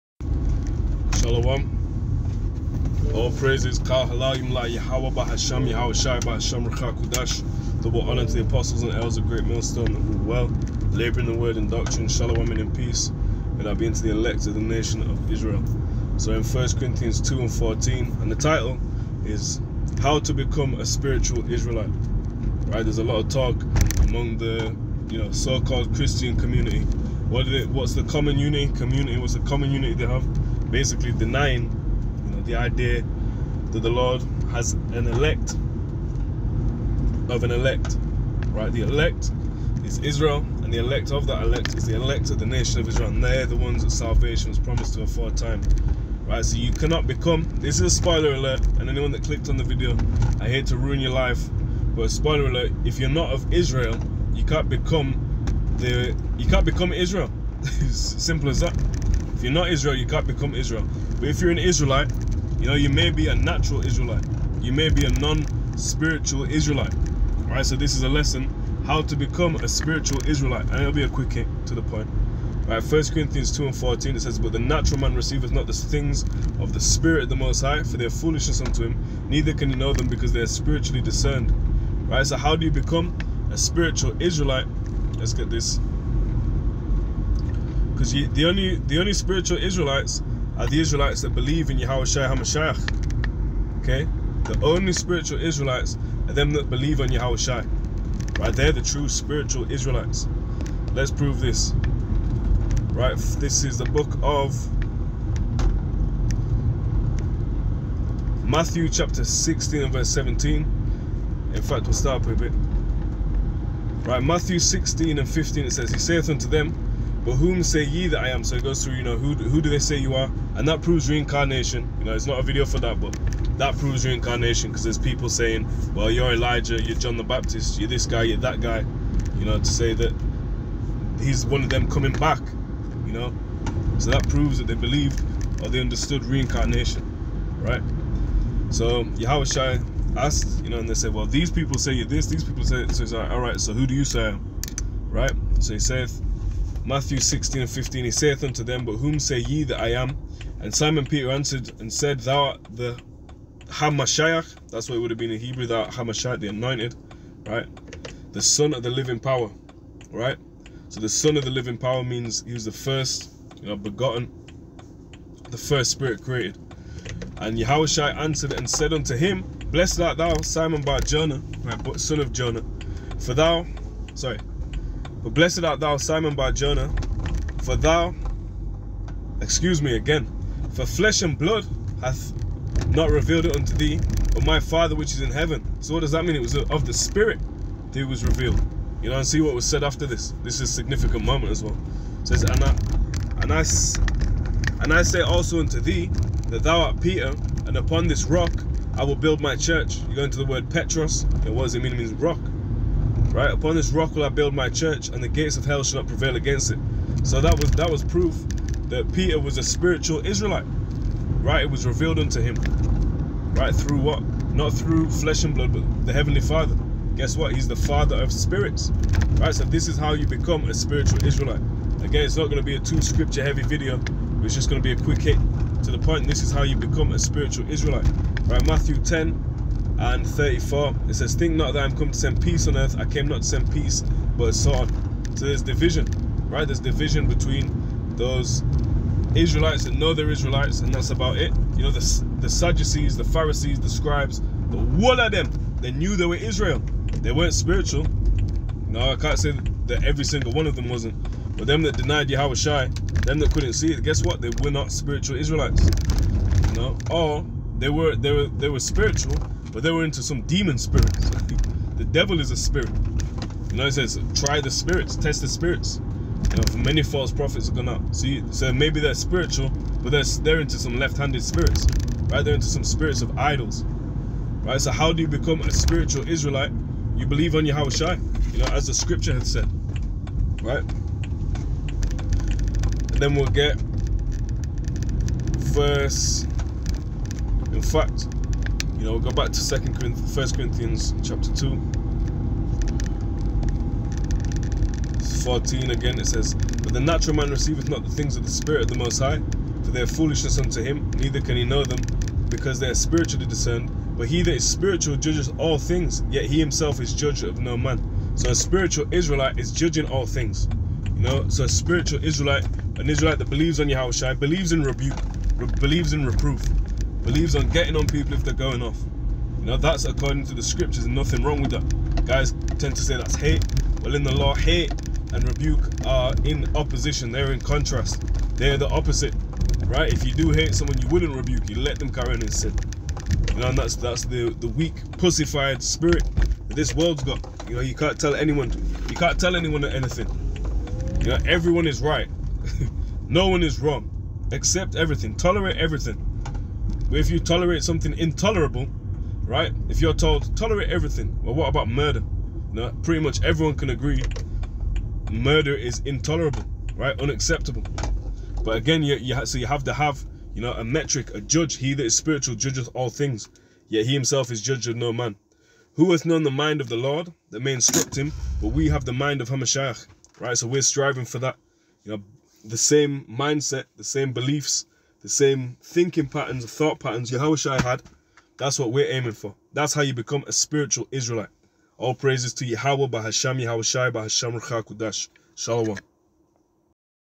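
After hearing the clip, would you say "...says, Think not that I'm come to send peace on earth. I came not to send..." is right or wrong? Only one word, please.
right.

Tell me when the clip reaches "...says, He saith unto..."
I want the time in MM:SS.
01:55.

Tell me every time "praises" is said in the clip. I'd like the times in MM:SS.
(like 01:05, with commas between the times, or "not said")
00:03, 06:22.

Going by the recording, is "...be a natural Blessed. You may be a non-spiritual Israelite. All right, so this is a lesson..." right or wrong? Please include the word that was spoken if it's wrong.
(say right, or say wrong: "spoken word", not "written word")
wrong: "Israelite", not "Blessed".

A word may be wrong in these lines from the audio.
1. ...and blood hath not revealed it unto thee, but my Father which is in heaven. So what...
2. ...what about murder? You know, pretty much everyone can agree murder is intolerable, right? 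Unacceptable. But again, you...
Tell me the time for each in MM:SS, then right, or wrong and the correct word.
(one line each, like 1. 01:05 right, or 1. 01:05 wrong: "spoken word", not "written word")
1. 03:01 right
2. 05:51 right.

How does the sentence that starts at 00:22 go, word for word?
Right, there's a lot of talk among the you know so-called Christian community.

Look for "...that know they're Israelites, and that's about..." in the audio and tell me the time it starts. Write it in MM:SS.
03:59.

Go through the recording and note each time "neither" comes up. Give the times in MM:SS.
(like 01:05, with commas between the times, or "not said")
01:19, 05:01.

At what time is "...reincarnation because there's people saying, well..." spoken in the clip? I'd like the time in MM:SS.
02:04.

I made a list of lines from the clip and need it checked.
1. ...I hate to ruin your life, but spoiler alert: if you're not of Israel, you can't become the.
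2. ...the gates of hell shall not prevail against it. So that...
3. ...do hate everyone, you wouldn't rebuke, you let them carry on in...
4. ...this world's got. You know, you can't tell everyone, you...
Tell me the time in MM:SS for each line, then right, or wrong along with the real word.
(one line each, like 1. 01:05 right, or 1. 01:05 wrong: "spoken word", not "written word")
1. 00:50 right
2. 03:25 right
3. 05:30 wrong: "someone", not "everyone"
4. 05:36 wrong: "anyone", not "everyone".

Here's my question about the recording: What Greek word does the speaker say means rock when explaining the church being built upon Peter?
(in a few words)
Petros.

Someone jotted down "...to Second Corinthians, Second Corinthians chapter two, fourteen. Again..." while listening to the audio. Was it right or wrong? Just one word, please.
wrong.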